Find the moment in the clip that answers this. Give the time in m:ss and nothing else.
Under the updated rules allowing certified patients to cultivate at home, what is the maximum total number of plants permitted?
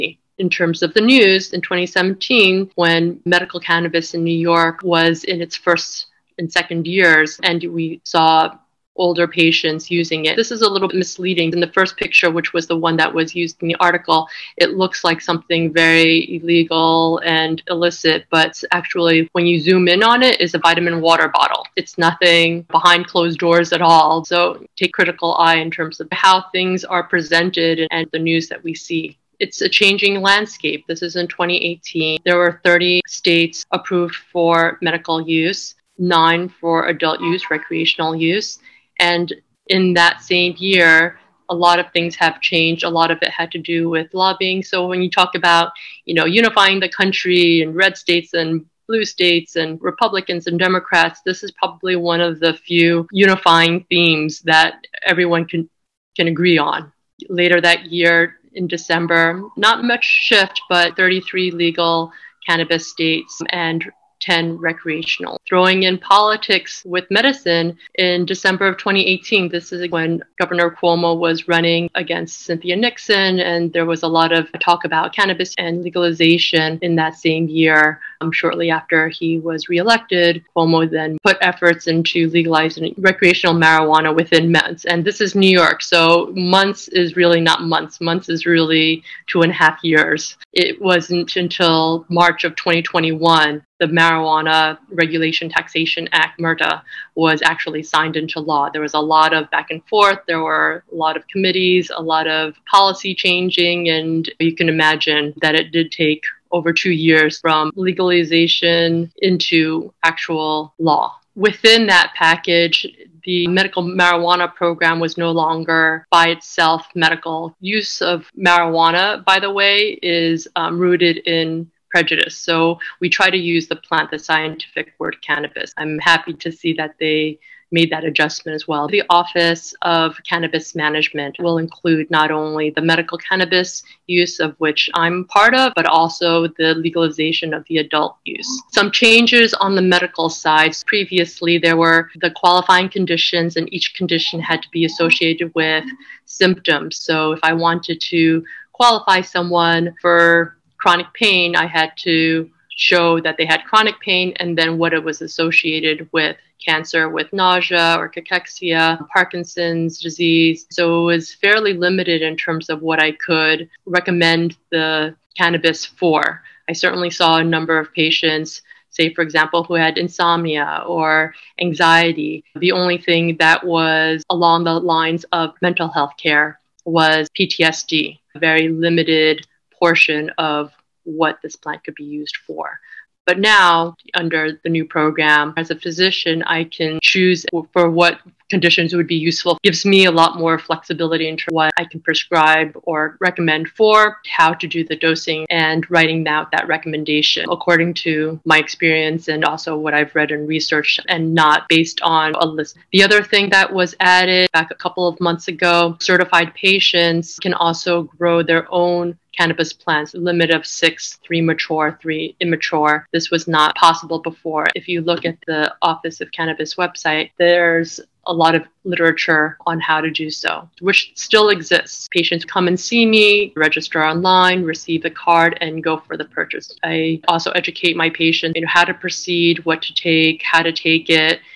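3:30.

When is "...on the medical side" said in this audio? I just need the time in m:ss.
2:19.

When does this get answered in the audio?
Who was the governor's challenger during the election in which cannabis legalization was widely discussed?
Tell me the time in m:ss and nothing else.
1:12.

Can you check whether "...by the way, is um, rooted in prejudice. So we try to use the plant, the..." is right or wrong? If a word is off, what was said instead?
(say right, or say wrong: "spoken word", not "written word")
right.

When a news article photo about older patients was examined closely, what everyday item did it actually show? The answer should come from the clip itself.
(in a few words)
vitamin water bottle.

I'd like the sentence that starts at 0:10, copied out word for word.
This is a little bit misleading.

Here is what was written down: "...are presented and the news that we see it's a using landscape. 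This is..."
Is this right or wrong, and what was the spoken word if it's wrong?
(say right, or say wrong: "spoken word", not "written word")
wrong: "changing", not "using".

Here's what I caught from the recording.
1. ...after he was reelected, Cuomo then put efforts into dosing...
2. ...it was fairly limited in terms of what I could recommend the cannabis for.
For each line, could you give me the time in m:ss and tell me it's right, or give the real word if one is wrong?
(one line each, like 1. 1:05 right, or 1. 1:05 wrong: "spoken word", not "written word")
1. 1:18 wrong: "legalizing", not "dosing"
2. 2:41 right.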